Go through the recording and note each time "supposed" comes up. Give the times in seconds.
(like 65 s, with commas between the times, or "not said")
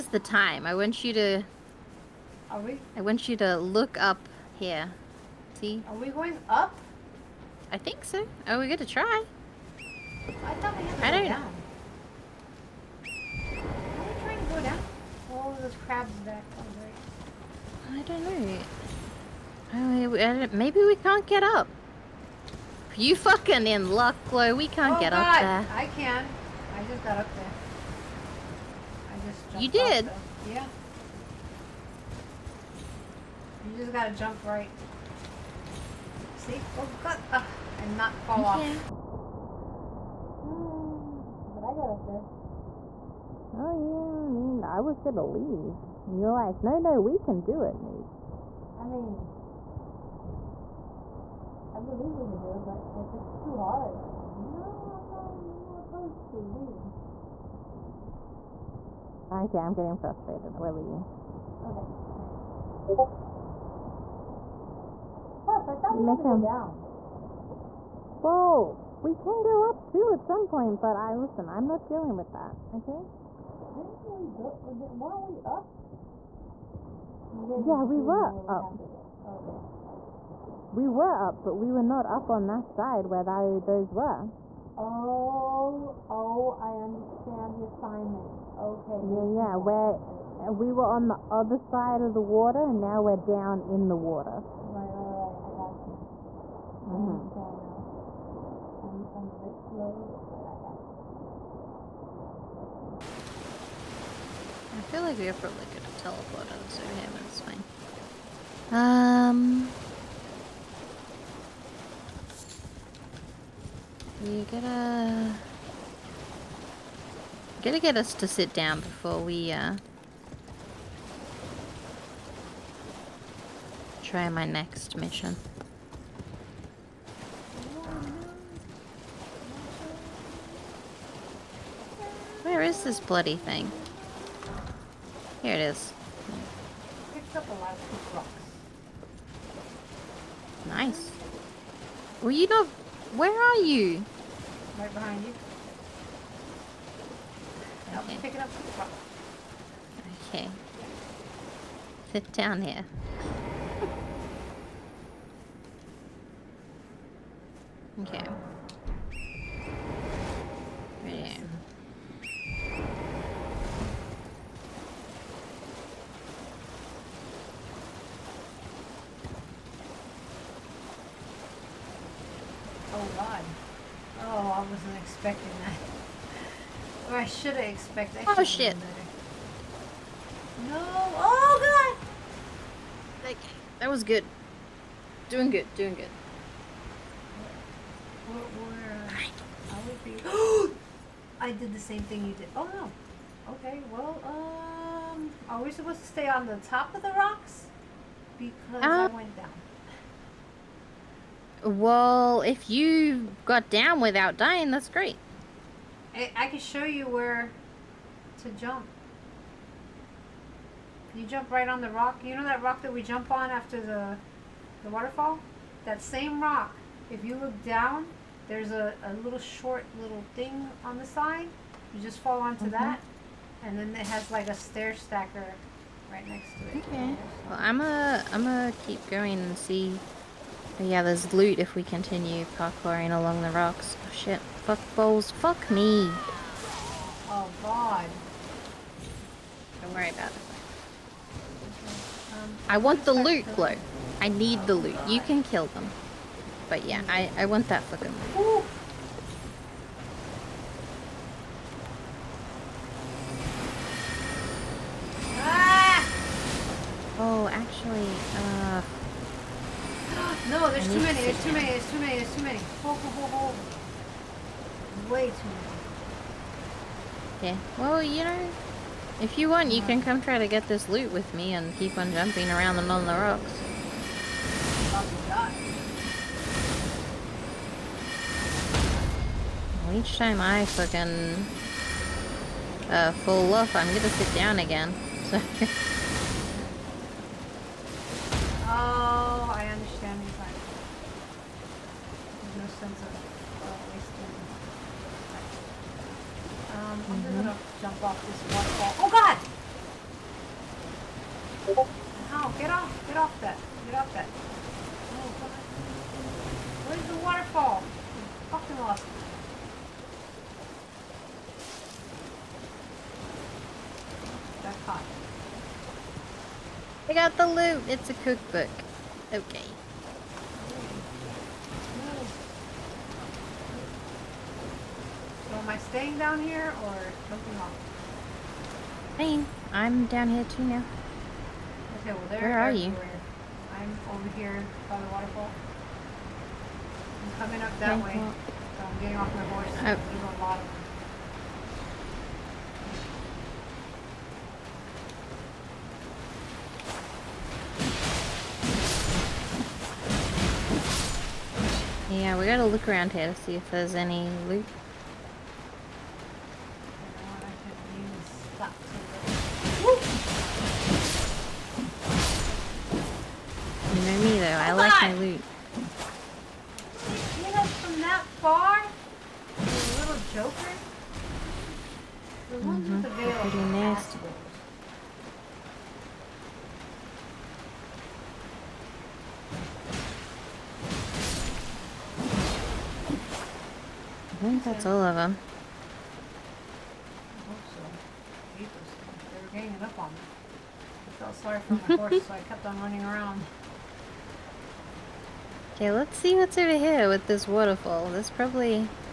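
195 s.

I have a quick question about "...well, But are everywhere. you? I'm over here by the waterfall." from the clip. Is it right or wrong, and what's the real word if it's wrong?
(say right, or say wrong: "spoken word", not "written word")
wrong: "Where", not "But".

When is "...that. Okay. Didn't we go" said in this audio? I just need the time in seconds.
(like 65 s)
72 s.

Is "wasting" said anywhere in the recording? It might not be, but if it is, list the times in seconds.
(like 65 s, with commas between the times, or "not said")
293 s.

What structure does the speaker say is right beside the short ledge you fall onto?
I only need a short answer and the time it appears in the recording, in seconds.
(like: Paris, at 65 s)
A stair stacker, at 224 s.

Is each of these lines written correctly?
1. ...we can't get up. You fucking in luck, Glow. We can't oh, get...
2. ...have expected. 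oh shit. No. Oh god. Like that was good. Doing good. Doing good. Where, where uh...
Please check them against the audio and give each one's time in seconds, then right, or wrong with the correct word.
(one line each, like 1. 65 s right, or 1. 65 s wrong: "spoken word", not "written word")
1. 20 s right
2. 177 s right.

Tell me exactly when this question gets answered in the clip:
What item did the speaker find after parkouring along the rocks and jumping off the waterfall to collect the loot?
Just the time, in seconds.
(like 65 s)
317 s.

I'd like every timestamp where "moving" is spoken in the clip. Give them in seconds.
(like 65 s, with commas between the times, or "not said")
327 s.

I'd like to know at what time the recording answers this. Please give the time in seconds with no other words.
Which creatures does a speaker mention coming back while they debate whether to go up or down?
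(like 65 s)
15 s.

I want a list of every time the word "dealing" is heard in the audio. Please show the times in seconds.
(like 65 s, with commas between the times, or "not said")
71 s.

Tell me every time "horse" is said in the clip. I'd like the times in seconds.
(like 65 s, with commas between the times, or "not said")
339 s, 391 s.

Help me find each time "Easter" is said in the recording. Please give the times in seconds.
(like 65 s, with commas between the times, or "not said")
not said.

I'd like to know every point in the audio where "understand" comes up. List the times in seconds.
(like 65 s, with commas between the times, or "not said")
86 s, 97 s, 289 s.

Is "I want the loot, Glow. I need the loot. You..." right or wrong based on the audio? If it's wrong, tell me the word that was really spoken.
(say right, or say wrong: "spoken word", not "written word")
right.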